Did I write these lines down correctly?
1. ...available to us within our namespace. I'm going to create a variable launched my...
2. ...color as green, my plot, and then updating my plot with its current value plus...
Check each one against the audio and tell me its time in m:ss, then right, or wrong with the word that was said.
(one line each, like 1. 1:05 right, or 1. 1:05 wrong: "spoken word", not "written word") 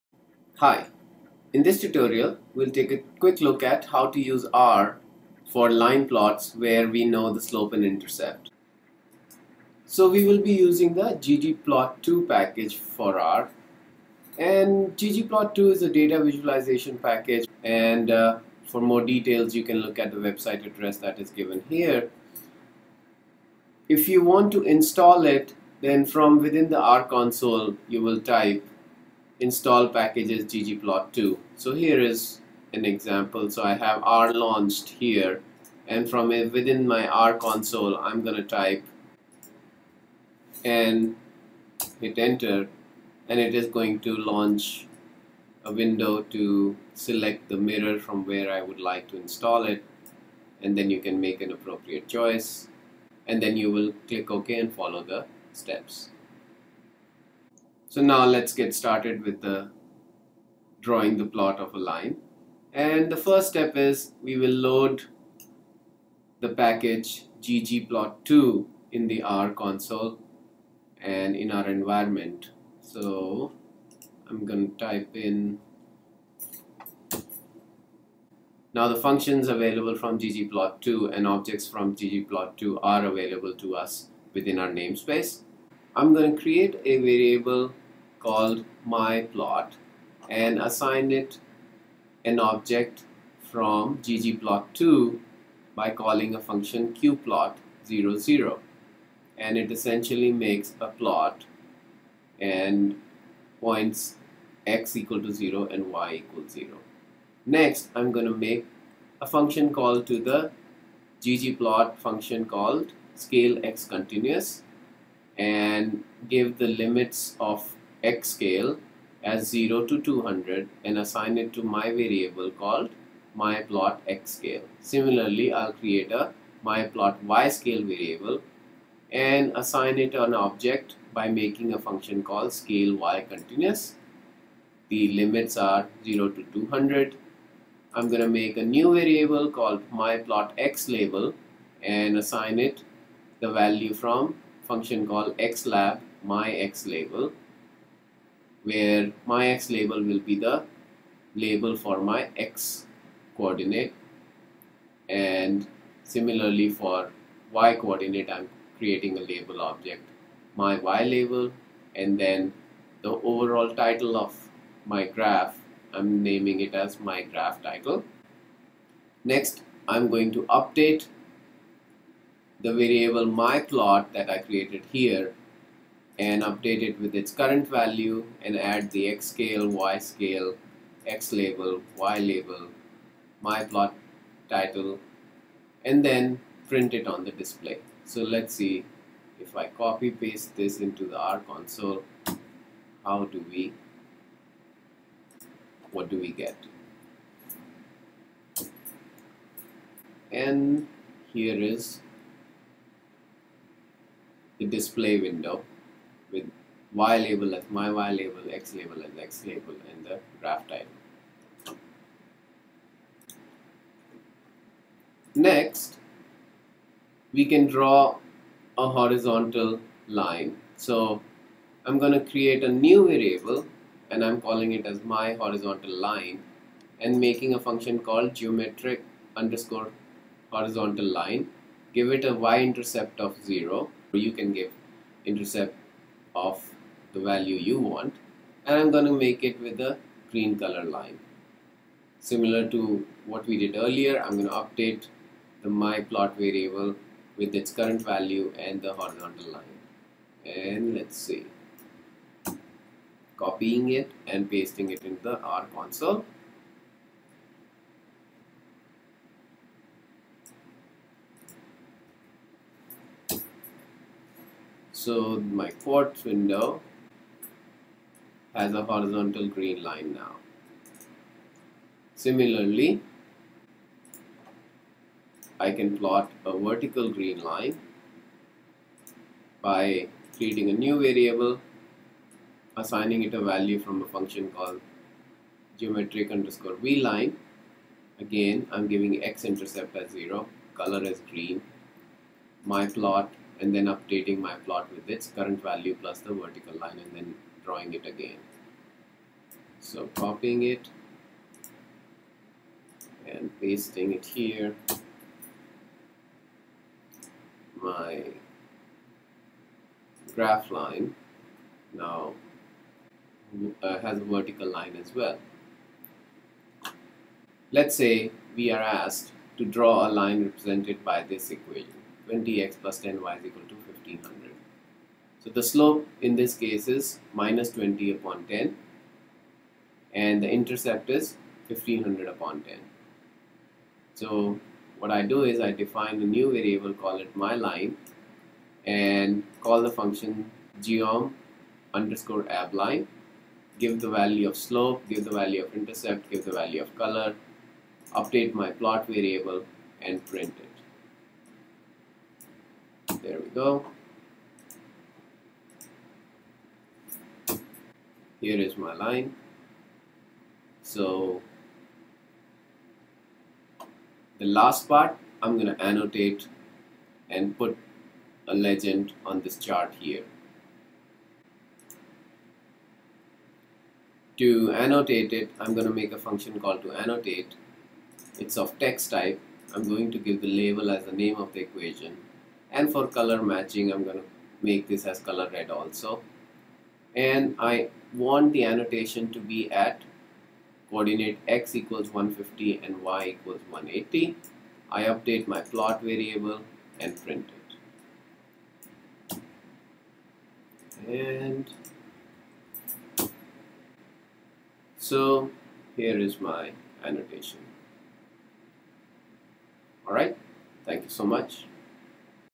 1. 1:23 wrong: "called", not "launched"
2. 4:50 right.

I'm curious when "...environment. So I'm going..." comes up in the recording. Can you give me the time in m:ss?
1:11.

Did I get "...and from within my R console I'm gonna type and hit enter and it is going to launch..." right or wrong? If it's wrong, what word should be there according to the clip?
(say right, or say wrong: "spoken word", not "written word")
right.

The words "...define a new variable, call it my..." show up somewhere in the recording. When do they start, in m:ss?
5:35.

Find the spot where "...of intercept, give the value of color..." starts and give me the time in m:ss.
5:45.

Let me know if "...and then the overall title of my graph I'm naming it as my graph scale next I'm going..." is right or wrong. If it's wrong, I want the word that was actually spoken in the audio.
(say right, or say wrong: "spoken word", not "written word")
wrong: "title", not "scale".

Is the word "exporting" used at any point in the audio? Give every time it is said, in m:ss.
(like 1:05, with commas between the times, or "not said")
not said.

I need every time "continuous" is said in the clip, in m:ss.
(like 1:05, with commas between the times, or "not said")
1:53, 2:13.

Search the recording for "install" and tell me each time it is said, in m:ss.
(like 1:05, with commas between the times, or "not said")
0:24, 0:29, 0:49.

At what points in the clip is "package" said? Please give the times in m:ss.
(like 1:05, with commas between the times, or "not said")
0:12, 0:16, 0:29, 1:06.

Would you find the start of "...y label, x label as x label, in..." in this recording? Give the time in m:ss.
3:27.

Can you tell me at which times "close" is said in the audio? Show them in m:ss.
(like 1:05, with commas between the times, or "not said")
not said.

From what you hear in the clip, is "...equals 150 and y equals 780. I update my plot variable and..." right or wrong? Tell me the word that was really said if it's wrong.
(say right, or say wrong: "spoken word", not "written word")
wrong: "180", not "780".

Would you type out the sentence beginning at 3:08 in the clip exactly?
So let's see if I copy paste this into the R console, how do we, what do we get?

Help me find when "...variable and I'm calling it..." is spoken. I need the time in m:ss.
3:43.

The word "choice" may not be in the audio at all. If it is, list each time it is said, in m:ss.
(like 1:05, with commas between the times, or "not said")
0:52.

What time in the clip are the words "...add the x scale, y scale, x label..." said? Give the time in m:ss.
2:58.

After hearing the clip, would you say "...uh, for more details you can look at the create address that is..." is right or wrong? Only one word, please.
wrong.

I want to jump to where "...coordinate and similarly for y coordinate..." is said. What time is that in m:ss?
2:33.